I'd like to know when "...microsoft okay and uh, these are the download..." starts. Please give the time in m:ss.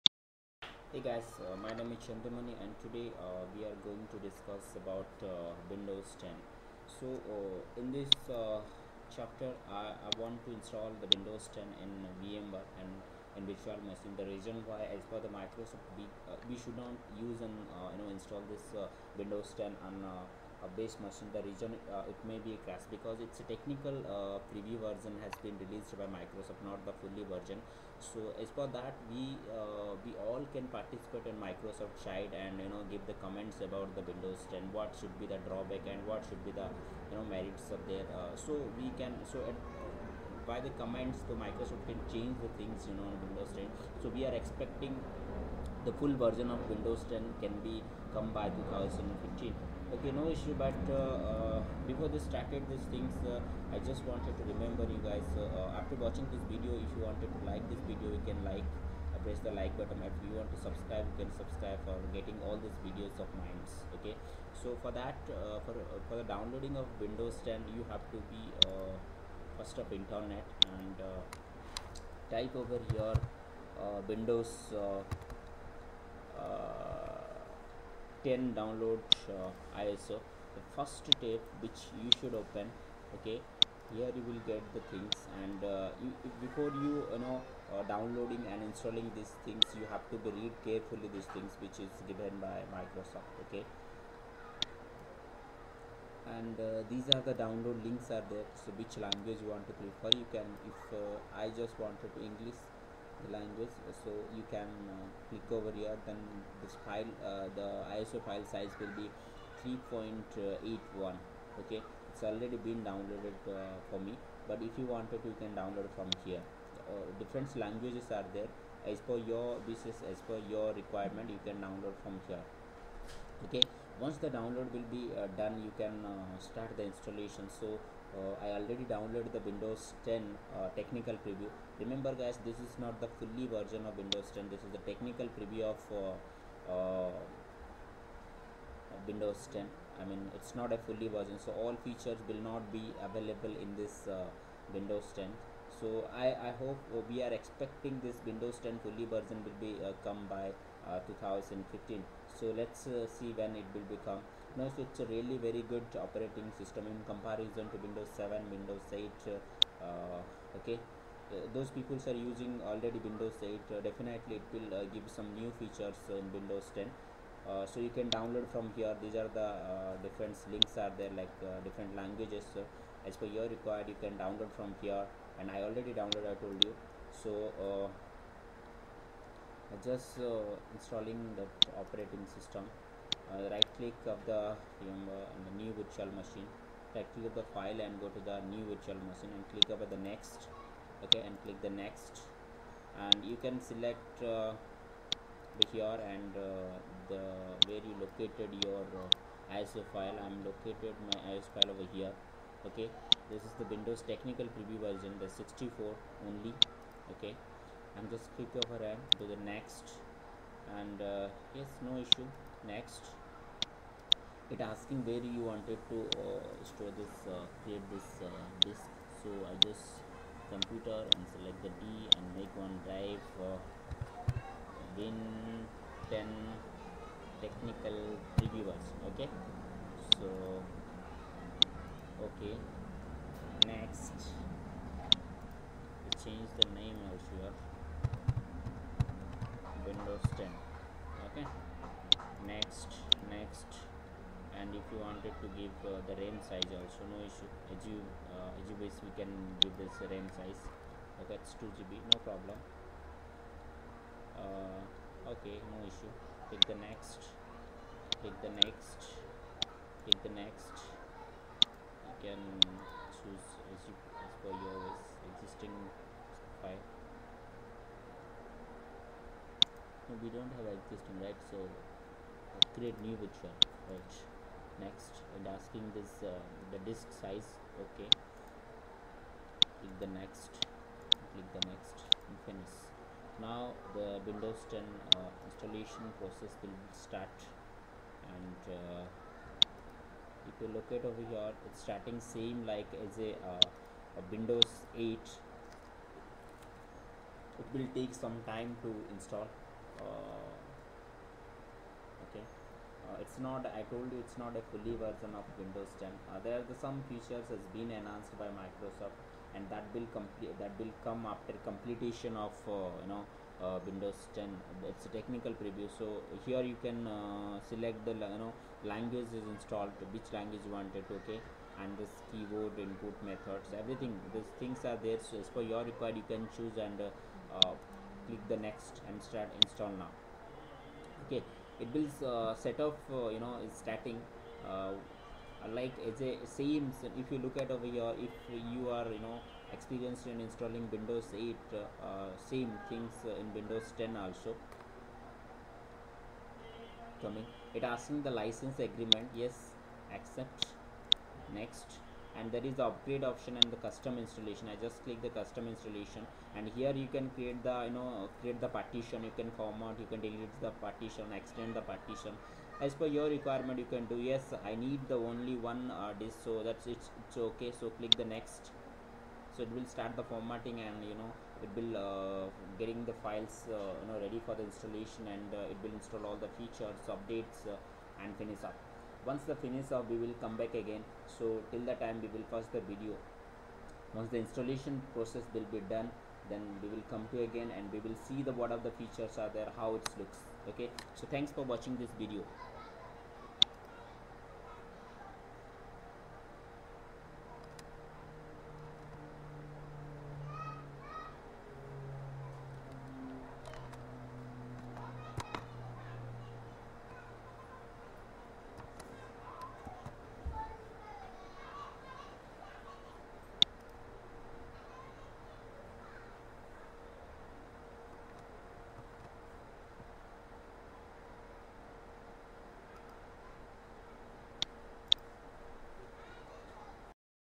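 1:32.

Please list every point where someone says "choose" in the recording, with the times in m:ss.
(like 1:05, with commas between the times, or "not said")
4:23, 5:26.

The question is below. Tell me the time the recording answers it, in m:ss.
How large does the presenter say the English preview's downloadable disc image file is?
1:49.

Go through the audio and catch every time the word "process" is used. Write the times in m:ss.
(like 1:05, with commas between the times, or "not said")
4:46, 6:25.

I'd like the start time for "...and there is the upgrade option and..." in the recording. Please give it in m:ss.
5:52.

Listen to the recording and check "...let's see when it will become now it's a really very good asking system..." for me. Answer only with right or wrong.
wrong.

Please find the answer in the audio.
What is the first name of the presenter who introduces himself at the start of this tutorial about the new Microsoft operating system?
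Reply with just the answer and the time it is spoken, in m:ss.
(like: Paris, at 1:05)
Chandramani, at 0:02.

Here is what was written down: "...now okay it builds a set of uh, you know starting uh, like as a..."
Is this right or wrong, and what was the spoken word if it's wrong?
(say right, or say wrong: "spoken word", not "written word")
right.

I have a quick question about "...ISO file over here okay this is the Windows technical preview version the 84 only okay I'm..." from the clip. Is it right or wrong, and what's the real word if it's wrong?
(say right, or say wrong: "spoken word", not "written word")
wrong: "64", not "84".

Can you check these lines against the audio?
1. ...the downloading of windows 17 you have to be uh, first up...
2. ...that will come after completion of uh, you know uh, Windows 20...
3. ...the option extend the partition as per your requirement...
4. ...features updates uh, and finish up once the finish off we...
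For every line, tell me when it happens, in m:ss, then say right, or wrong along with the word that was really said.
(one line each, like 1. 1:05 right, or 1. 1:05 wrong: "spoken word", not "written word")
1. 1:06 wrong: "10", not "17"
2. 5:10 wrong: "10", not "20"
3. 6:00 wrong: "partition", not "option"
4. 6:16 right.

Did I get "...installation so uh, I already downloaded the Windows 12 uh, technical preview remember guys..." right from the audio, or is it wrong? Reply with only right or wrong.
wrong.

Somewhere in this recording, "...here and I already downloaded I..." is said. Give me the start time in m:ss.
2:54.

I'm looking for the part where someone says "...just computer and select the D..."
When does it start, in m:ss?
3:39.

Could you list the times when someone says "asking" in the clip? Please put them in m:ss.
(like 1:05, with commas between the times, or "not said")
3:34, 4:35, 5:47.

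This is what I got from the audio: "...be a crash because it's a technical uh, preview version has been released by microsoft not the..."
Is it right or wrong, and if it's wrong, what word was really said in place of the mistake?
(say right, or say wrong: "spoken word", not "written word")
right.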